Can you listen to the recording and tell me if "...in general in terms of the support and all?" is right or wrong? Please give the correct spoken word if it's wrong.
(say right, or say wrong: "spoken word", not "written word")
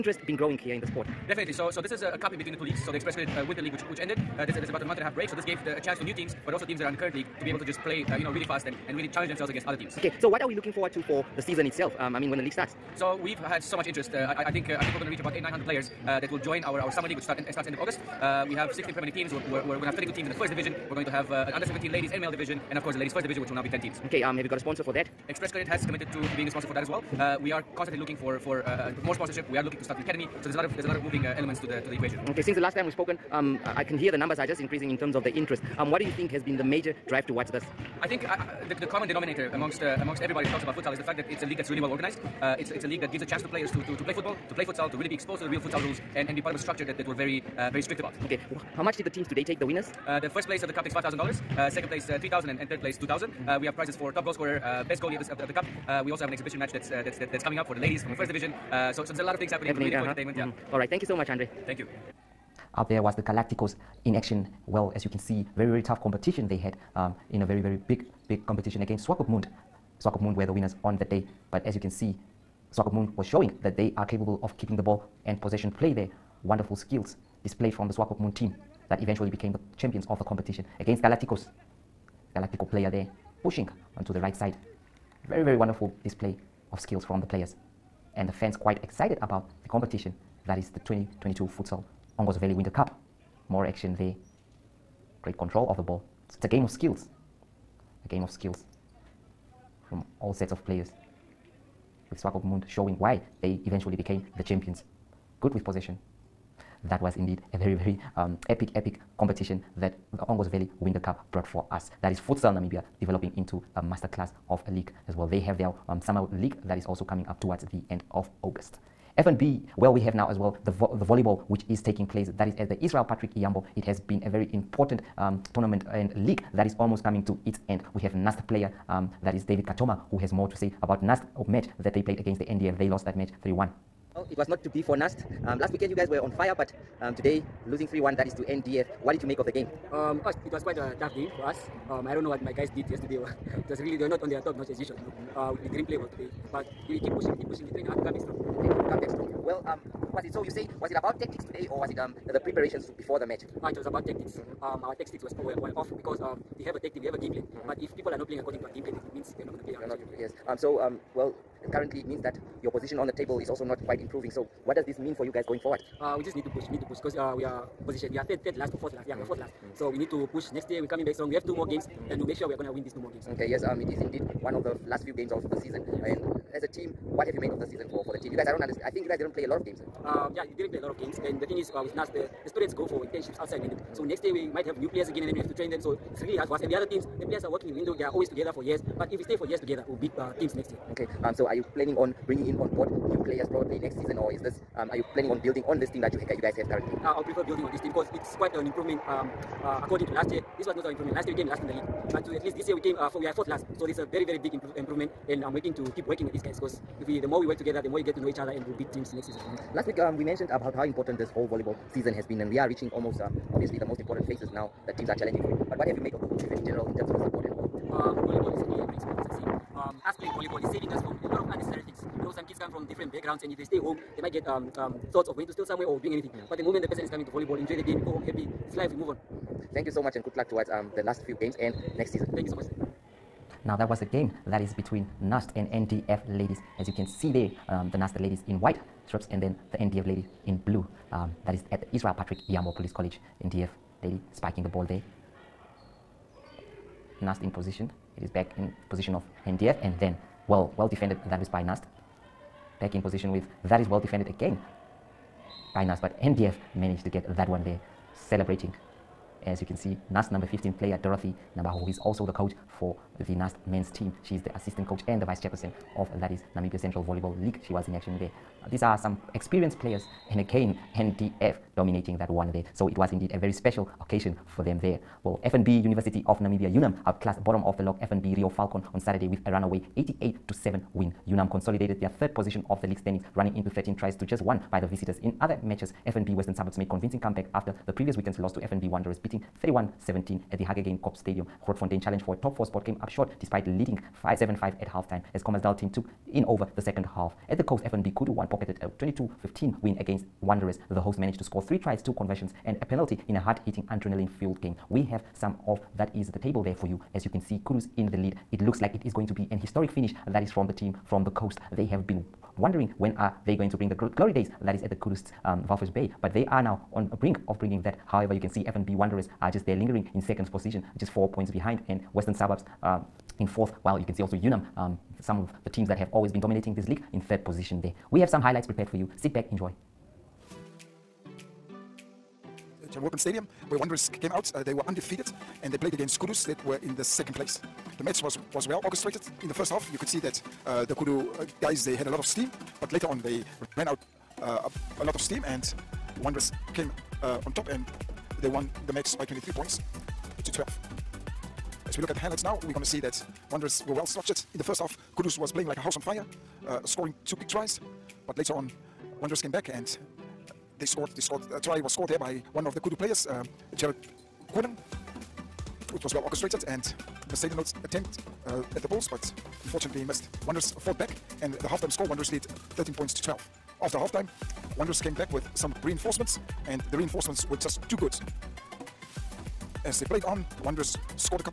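right.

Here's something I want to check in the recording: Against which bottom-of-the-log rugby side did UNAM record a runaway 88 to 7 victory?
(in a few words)
FNB Reho Falcon.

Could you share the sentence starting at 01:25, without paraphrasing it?
Very, very wonderful display of skills from the players.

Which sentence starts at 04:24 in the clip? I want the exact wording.
She is the assistant coach and the vice chairperson of that is Namibia Central Volleyball League.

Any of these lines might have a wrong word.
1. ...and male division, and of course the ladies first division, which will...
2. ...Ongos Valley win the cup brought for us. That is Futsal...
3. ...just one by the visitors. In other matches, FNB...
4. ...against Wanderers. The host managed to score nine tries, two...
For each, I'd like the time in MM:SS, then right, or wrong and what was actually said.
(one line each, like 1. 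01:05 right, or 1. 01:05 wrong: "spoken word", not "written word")
1. 00:22 right
2. 01:50 right
3. 04:44 right
4. 04:59 wrong: "three", not "nine".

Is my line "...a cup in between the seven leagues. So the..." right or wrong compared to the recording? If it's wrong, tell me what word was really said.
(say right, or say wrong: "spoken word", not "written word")
wrong: "two", not "seven".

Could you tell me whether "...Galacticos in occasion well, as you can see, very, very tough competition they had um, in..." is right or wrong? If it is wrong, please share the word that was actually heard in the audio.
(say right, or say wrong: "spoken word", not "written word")
wrong: "action", not "occasion".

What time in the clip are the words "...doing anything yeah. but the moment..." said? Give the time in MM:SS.
03:45.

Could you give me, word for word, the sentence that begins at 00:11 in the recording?
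Um, I mean, when the league starts?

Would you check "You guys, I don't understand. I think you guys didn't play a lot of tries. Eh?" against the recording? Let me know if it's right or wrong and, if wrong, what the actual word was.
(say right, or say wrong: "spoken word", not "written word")
wrong: "games", not "tries".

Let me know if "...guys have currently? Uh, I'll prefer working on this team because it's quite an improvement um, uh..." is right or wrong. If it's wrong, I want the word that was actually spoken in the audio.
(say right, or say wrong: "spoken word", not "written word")
wrong: "building", not "working".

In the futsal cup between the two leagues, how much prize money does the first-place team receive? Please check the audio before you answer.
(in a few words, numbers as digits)
$5,000.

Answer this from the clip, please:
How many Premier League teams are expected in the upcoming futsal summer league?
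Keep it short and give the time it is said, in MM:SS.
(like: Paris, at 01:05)
16, at 00:18.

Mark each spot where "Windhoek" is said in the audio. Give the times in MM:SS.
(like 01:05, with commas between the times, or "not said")
03:03, 03:07.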